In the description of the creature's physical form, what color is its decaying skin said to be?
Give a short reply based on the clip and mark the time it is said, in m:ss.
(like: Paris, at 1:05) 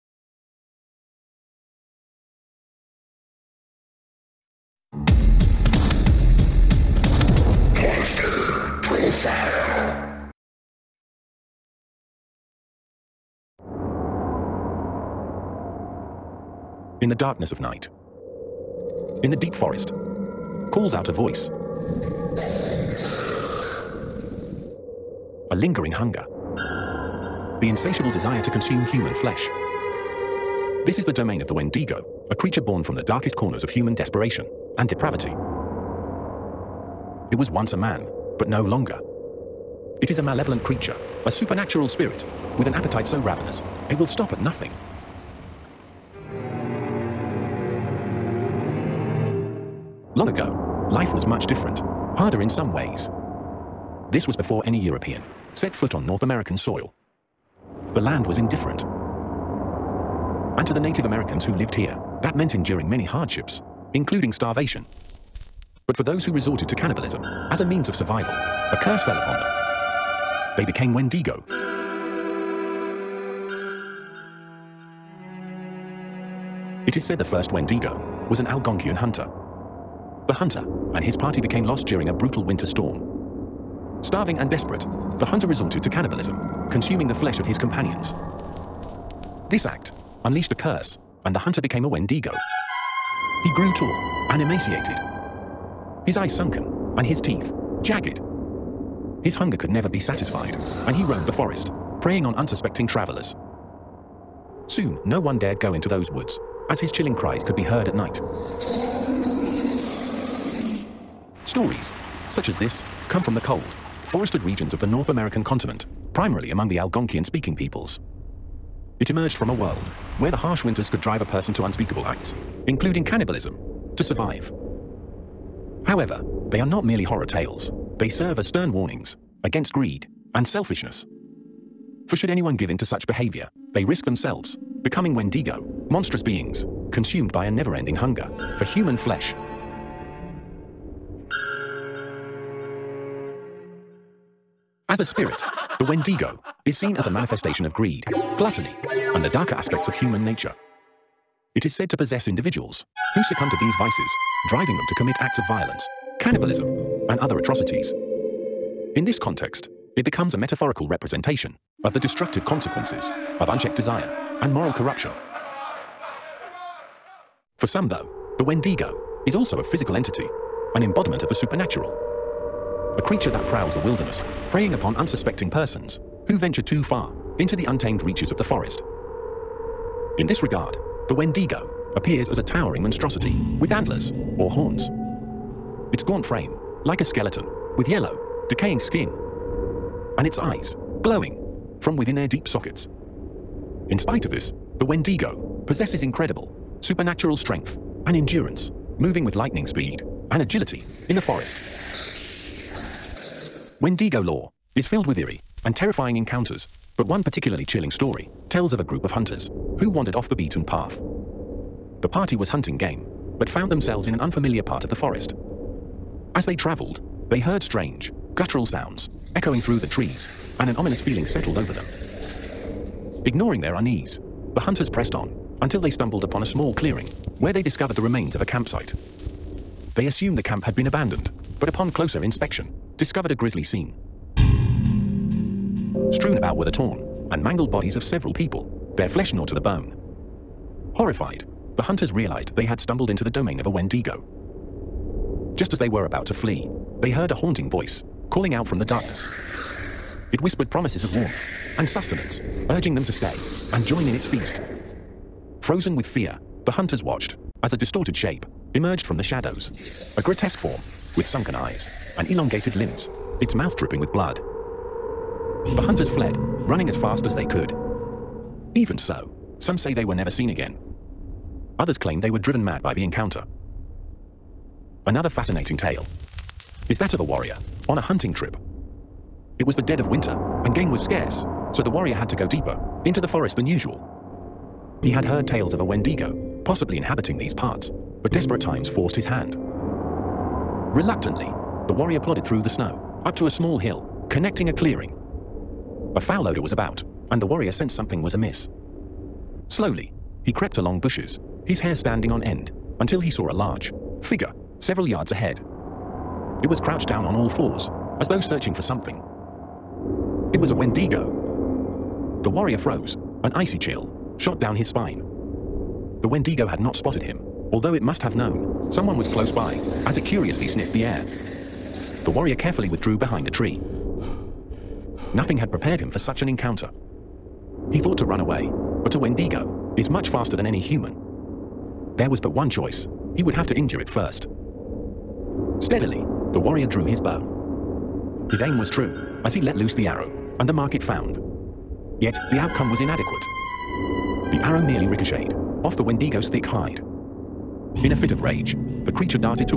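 Yellow, at 3:07.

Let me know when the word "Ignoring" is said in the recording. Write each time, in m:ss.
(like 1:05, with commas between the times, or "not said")
3:43.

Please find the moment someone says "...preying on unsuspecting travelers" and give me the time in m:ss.
1:42.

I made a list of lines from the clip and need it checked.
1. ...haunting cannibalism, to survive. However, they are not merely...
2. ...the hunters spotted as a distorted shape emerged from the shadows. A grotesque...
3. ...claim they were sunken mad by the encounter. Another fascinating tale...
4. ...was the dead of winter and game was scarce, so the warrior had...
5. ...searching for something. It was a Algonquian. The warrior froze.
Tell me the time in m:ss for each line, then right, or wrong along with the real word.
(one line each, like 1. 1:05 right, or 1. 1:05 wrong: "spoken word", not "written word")
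1. 2:02 wrong: "including", not "haunting"
2. 4:16 wrong: "watched", not "spotted"
3. 4:31 wrong: "driven", not "sunken"
4. 4:39 right
5. 5:08 wrong: "Wendigo", not "Algonquian".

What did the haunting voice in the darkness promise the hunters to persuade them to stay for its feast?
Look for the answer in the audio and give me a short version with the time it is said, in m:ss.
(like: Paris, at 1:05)
Warmth and sustenance, at 4:11.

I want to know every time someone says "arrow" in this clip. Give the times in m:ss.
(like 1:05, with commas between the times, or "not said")
5:40, 5:44.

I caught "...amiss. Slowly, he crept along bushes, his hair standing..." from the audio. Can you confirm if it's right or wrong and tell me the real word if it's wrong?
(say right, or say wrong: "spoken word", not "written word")
right.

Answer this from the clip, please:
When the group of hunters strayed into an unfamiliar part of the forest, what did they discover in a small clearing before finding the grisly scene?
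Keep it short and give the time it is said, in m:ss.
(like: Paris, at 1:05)
Remains of a campsite, at 3:47.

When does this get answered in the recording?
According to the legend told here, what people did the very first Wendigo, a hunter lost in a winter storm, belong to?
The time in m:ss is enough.
1:18.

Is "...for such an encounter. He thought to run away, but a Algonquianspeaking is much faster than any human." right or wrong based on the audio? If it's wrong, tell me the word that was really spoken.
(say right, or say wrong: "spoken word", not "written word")
wrong: "Wendigo", not "Algonquianspeaking".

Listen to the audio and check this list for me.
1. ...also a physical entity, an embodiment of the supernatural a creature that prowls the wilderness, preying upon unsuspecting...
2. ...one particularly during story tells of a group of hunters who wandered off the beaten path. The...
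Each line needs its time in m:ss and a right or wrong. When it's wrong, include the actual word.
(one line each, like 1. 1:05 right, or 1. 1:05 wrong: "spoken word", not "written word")
1. 2:49 right
2. 3:27 wrong: "chilling", not "during".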